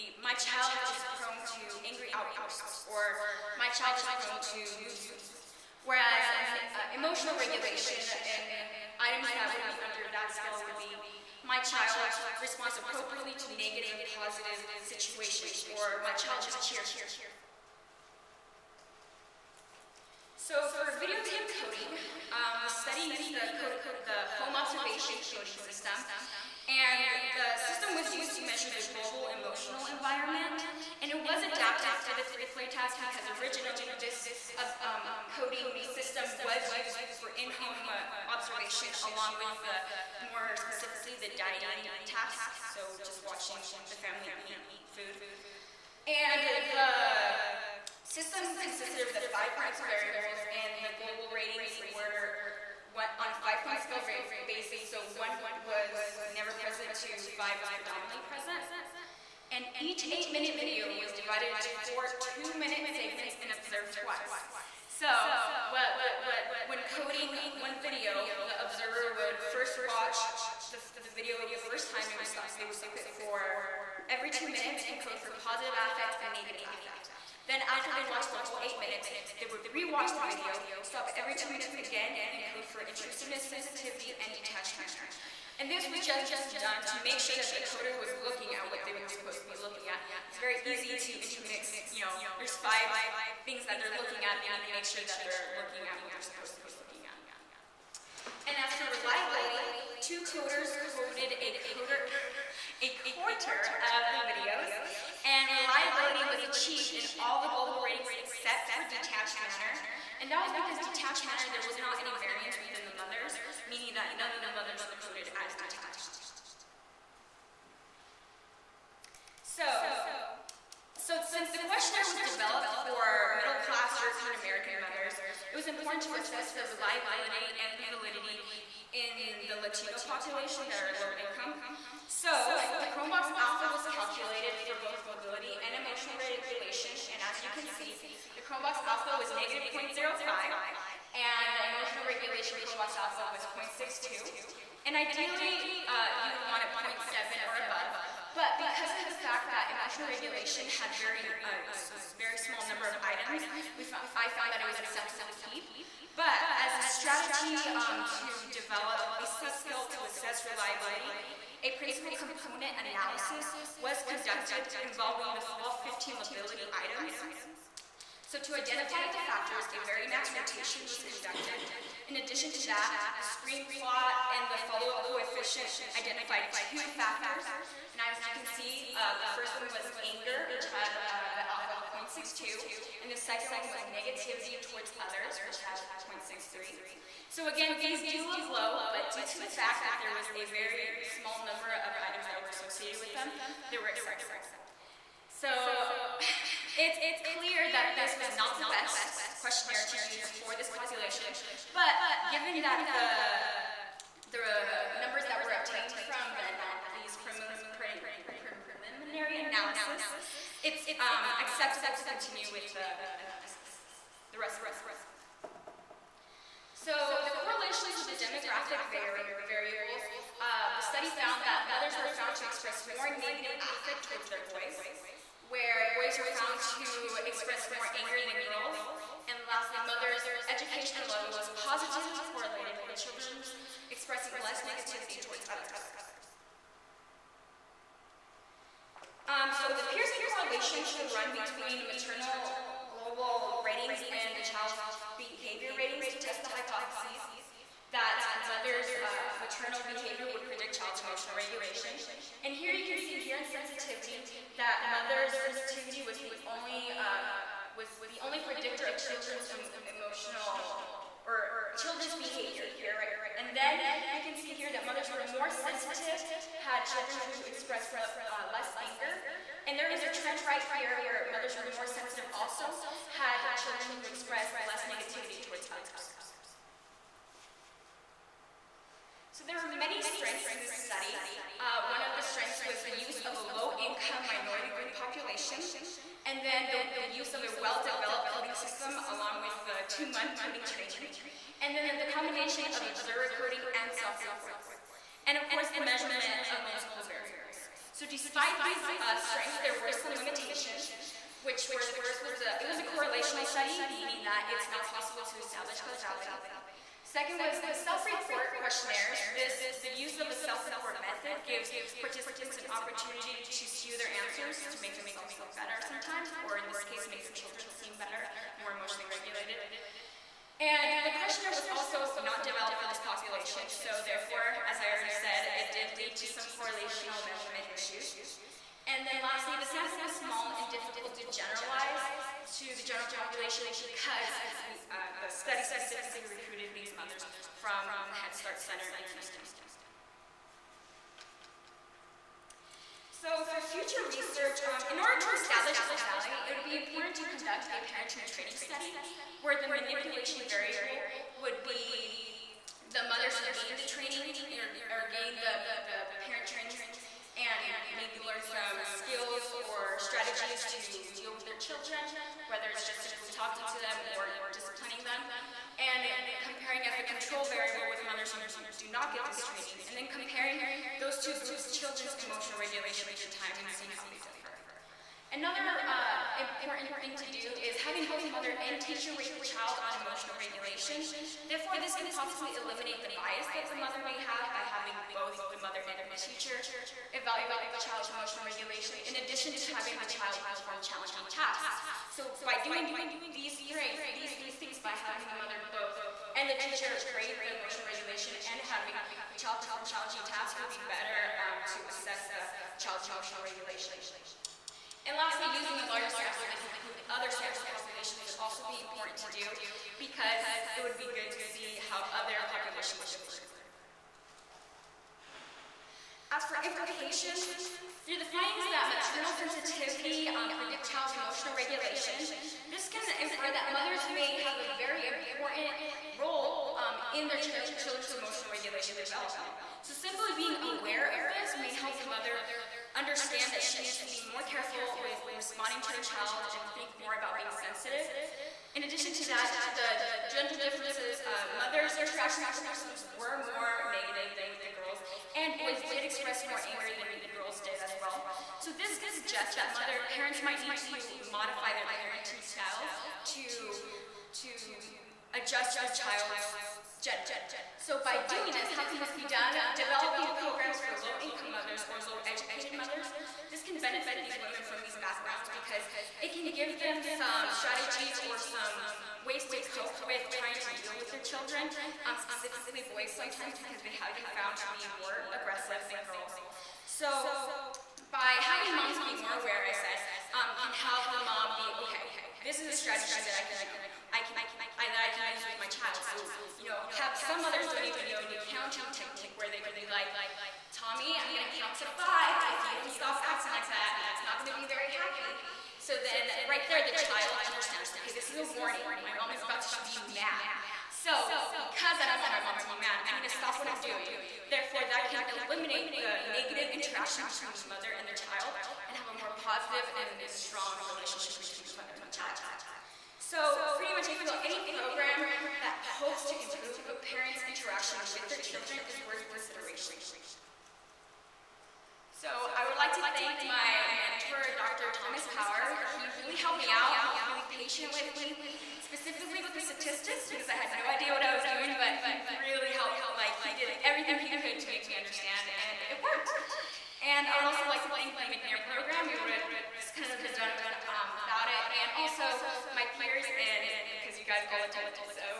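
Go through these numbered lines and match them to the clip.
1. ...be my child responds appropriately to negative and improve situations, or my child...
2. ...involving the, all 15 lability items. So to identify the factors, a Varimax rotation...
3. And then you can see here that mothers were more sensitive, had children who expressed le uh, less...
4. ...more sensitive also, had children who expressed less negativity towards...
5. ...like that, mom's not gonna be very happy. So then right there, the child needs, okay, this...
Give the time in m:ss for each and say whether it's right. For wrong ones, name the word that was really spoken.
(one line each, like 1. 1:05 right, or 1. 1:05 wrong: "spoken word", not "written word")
1. 0:10 wrong: "positive", not "improve"
2. 2:44 right
3. 4:23 right
4. 4:31 right
5. 8:13 wrong: "understands", not "needs".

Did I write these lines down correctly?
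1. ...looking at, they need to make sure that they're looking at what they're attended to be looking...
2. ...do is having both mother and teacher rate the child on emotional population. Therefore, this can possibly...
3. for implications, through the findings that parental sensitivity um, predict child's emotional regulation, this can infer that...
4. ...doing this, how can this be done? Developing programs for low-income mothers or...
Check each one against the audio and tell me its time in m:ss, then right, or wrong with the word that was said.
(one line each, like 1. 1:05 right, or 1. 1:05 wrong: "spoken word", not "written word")
1. 1:33 wrong: "supposed", not "attended"
2. 6:17 wrong: "regulation", not "population"
3. 6:56 wrong: "maternal", not "parental"
4. 7:38 right.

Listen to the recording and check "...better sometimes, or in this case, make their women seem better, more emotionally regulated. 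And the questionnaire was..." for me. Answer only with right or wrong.
wrong.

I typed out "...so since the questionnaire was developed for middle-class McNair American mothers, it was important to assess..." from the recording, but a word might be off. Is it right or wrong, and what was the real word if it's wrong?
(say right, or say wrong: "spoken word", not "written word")
wrong: "European", not "McNair".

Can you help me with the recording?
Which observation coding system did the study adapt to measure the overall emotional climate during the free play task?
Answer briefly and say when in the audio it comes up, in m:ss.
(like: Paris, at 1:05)
home observation coding system, at 0:24.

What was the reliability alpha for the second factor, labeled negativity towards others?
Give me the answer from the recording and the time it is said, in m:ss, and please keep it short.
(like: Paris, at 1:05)
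0.63, at 3:06.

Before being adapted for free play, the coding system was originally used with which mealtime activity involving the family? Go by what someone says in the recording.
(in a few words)
dining task.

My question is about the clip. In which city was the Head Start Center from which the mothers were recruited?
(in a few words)
Houston.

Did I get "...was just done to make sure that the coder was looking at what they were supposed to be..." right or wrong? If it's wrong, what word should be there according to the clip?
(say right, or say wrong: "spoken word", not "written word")
right.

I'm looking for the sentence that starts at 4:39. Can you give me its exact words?
So there were many strengths in this study.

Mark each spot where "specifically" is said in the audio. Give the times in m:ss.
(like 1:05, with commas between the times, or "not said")
0:40, 5:35, 7:52, 8:48.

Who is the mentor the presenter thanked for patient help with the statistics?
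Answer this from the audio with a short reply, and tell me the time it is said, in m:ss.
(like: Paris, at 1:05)
Dr. Thomas Power, at 8:44.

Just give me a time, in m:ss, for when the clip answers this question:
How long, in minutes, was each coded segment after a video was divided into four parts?
1:02.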